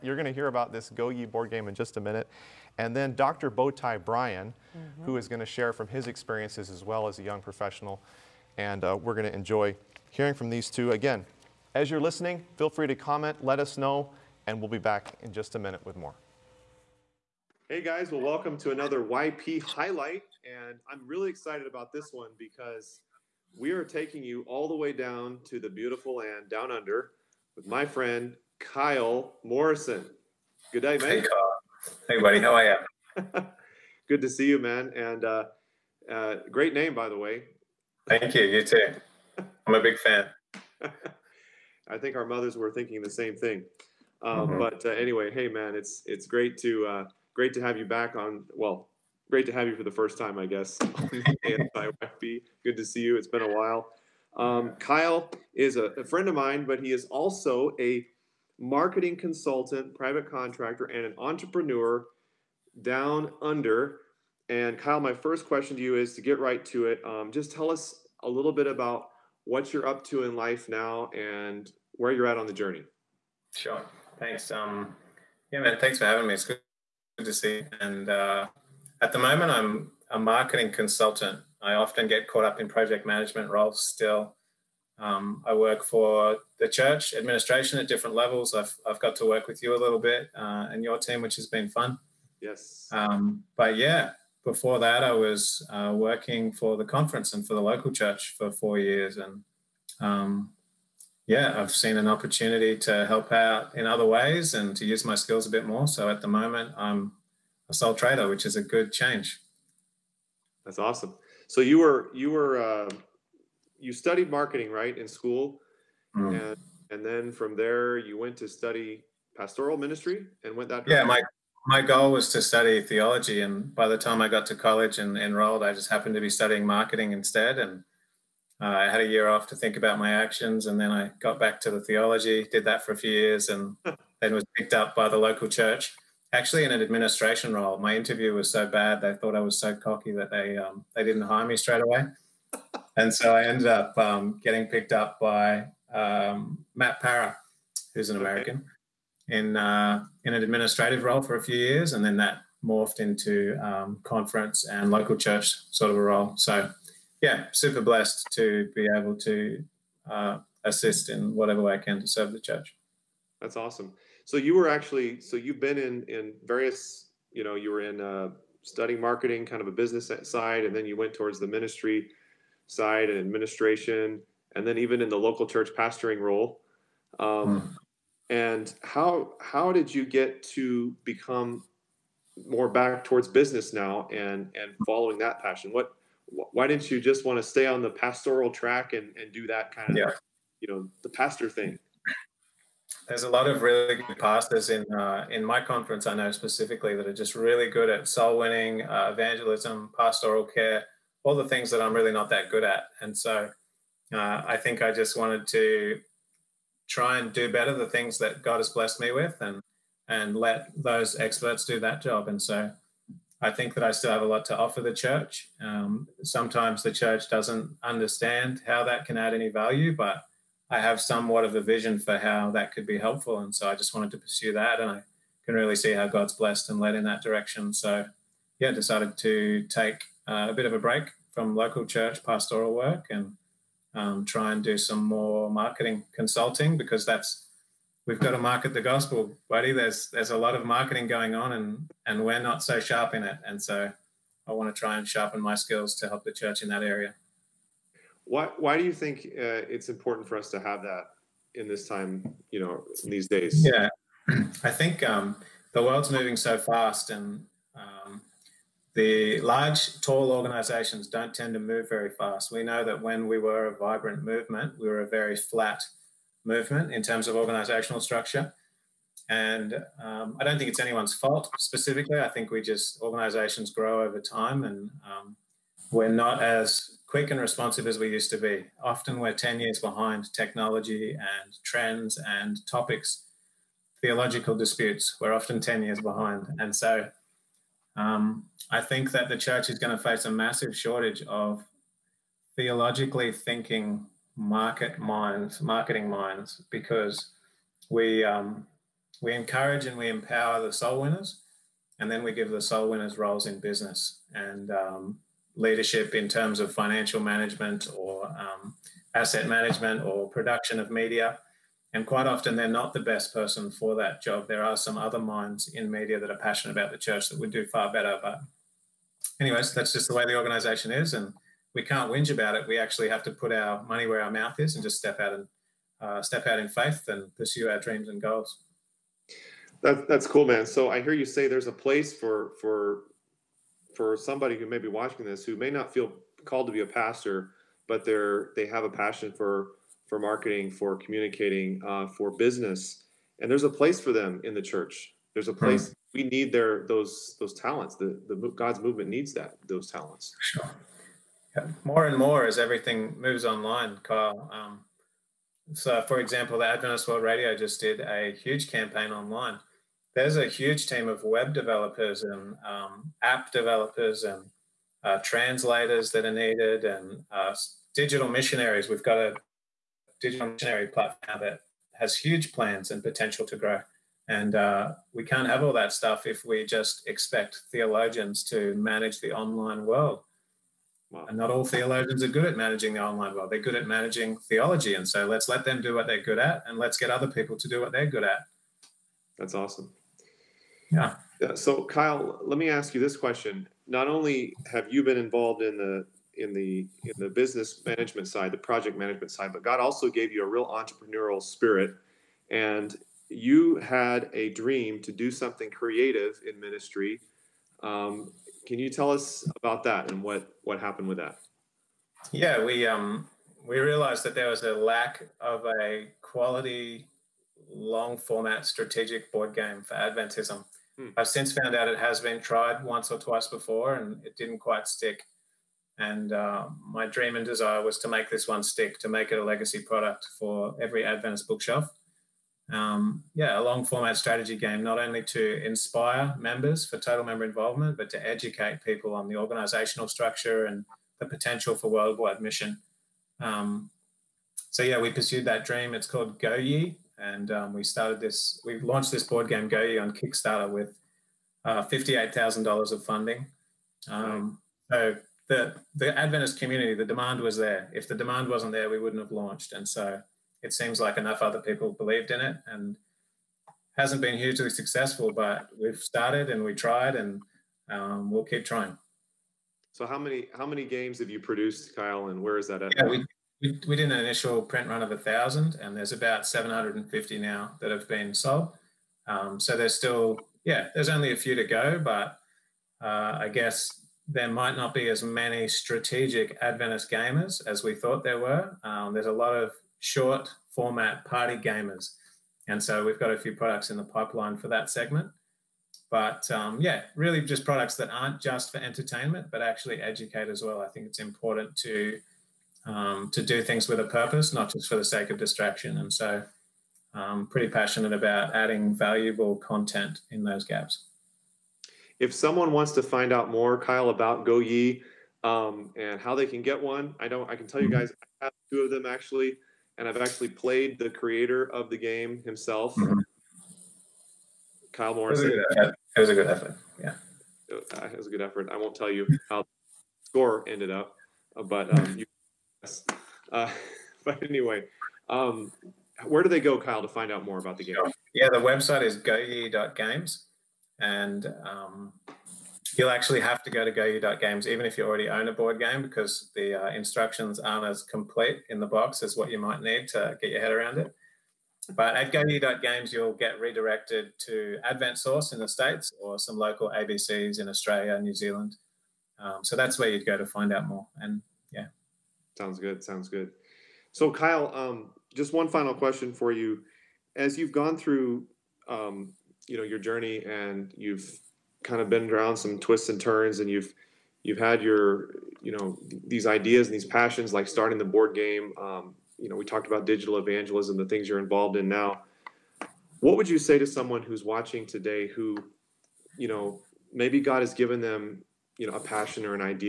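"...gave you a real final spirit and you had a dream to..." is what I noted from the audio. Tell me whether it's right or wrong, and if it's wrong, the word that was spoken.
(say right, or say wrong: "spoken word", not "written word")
wrong: "entrepreneurial", not "final".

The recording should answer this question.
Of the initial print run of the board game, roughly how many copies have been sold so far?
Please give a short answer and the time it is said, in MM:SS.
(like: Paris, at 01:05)
750, at 07:56.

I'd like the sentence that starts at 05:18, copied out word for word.
But, anyways, that's just the way the organization is.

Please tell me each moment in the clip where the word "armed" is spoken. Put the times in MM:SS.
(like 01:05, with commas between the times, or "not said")
not said.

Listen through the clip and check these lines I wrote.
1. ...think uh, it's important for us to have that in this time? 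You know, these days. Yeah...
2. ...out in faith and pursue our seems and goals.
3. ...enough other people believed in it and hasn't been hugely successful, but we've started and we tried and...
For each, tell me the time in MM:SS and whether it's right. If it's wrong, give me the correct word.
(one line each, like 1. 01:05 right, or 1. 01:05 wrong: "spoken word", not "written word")
1. 04:08 right
2. 05:26 wrong: "dreams", not "seems"
3. 07:41 right.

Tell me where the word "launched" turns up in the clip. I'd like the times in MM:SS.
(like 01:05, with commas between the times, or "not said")
07:28, 07:39.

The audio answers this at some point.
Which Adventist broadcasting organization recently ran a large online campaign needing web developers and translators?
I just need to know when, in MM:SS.
05:56.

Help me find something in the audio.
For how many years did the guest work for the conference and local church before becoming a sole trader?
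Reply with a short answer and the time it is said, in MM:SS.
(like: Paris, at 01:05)
4, at 01:38.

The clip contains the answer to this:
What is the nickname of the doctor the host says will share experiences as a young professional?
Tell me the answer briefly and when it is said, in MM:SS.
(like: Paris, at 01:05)
Bowtie Brian, at 00:03.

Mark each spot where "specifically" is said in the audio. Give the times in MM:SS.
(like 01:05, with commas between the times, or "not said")
03:16, 04:31.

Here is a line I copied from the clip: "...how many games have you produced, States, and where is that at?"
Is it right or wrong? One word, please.
wrong.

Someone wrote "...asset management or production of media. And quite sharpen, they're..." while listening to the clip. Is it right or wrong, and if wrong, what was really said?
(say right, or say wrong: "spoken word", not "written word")
wrong: "often", not "sharpen".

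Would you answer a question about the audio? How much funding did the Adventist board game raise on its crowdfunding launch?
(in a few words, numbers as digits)
$58,000.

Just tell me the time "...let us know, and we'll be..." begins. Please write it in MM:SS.
00:13.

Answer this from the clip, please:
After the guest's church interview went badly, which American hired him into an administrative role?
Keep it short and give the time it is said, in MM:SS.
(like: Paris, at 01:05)
Matt Para, at 02:26.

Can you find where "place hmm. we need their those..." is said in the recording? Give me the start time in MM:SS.
05:45.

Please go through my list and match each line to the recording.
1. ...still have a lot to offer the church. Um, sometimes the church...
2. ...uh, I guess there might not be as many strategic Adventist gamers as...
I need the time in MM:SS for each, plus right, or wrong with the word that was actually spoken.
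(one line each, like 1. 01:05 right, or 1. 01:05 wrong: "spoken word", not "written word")
1. 03:33 right
2. 08:03 right.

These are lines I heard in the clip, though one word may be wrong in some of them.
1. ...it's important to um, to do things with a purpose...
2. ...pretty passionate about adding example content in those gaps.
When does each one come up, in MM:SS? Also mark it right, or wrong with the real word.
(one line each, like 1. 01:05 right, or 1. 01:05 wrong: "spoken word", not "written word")
1. 08:21 right
2. 08:27 wrong: "valuable", not "example".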